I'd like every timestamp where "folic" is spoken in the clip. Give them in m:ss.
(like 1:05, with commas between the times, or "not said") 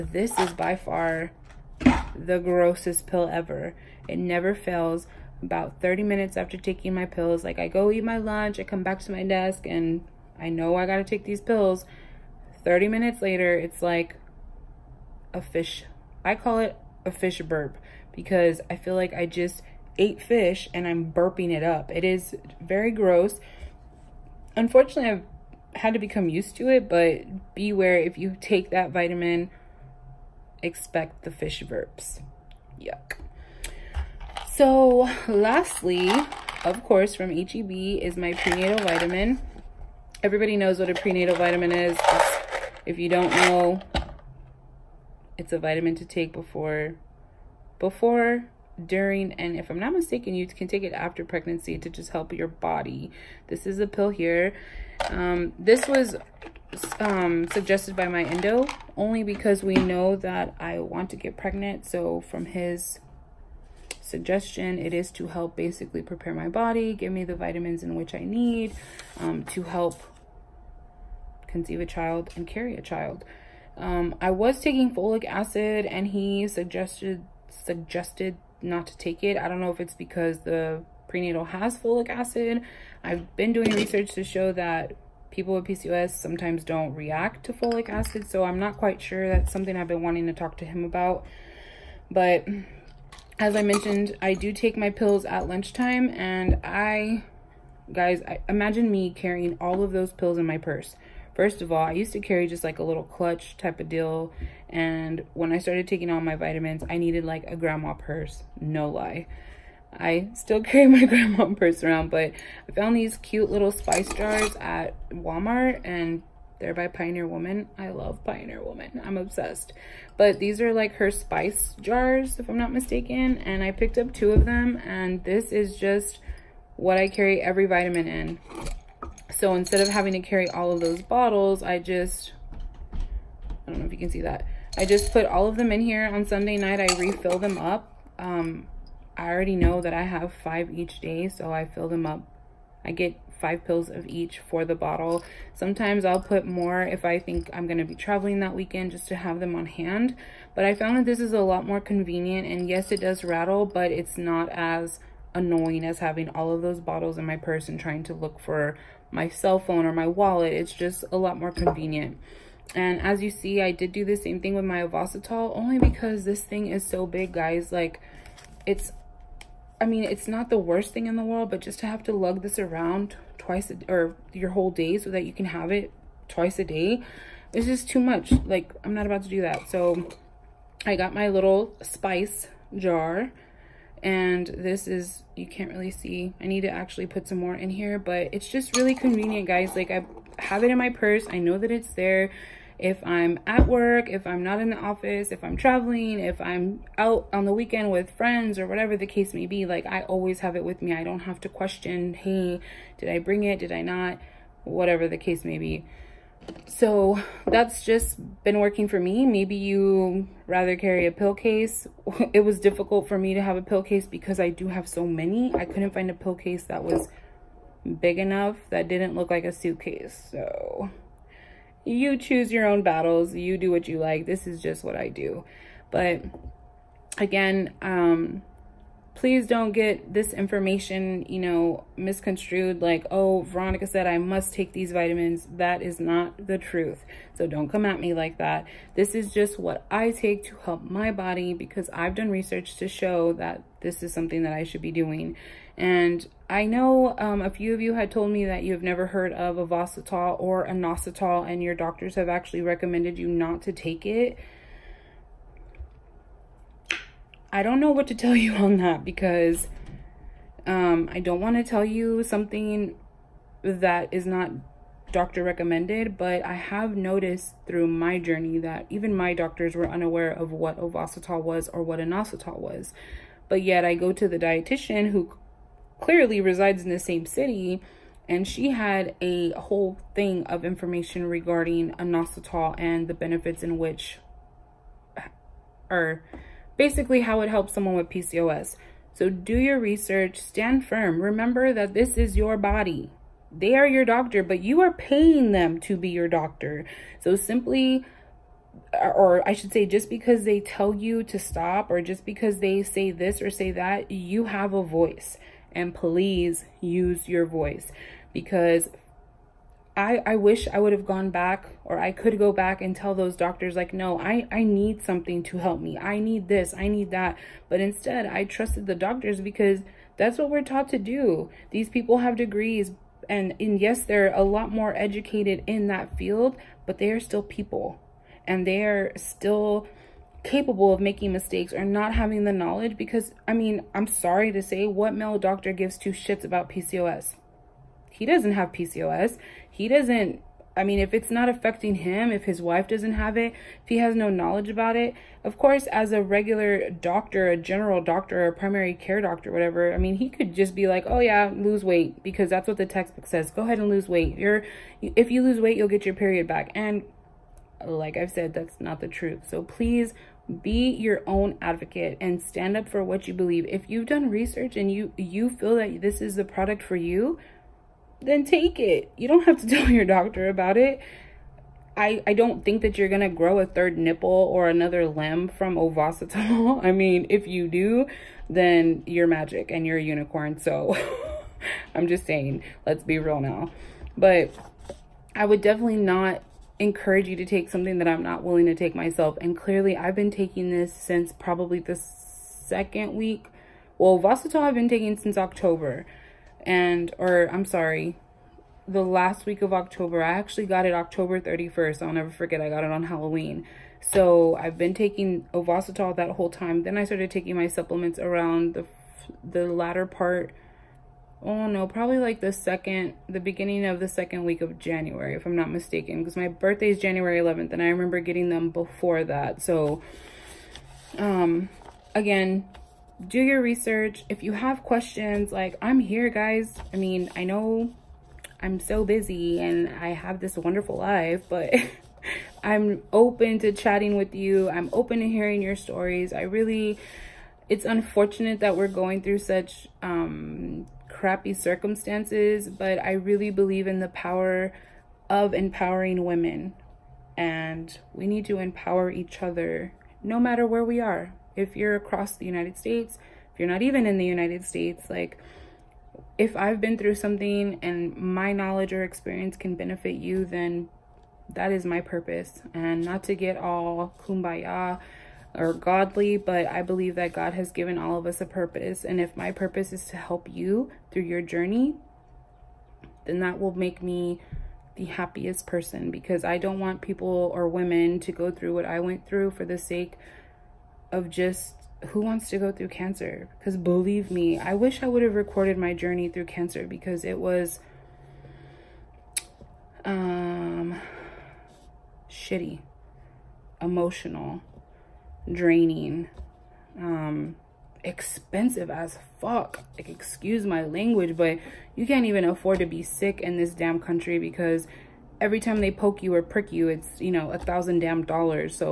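1:14, 1:21, 1:27.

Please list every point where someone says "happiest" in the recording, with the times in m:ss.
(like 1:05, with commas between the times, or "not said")
7:55.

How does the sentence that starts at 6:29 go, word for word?
And clearly, I've been taking this since probably the second week.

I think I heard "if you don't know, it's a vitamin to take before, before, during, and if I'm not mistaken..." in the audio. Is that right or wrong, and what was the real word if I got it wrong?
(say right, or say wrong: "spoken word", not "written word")
right.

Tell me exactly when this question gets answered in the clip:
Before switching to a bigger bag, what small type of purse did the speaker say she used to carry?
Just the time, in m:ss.
1:43.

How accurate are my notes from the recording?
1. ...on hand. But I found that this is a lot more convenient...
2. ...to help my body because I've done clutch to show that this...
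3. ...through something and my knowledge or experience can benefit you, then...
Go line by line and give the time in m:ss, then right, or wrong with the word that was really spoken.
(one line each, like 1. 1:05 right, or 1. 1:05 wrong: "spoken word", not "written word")
1. 2:29 right
2. 4:00 wrong: "research", not "clutch"
3. 7:36 right.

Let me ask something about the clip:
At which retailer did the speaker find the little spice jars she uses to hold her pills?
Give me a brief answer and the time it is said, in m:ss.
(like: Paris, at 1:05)
Walmart, at 1:55.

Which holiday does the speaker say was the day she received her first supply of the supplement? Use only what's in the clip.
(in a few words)
Halloween.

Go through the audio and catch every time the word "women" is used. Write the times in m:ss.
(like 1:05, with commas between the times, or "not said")
7:26, 7:57.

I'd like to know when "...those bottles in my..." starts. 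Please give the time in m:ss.
2:36.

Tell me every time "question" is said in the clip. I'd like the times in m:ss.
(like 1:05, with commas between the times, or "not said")
3:21, 7:04.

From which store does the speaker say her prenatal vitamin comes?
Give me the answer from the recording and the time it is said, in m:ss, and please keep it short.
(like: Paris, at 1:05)
HEB, at 0:37.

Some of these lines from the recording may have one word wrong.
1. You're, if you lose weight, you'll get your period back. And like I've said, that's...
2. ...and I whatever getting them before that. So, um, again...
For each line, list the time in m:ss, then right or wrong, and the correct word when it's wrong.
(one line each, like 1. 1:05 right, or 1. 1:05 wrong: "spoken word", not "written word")
1. 5:54 right
2. 6:57 wrong: "remember", not "whatever".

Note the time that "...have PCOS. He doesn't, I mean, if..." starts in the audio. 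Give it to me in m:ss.
5:38.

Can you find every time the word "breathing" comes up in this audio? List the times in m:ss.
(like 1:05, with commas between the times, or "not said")
not said.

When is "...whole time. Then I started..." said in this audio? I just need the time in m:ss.
6:46.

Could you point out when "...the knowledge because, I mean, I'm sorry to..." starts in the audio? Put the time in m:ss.
5:32.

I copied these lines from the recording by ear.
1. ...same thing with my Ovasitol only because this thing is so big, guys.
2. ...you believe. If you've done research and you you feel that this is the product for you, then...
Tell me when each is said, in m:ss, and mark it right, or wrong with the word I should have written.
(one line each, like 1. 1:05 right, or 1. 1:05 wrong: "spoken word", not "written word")
1. 2:44 right
2. 6:03 right.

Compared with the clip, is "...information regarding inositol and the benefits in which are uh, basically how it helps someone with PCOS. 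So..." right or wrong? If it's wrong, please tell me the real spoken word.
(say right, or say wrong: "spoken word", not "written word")
right.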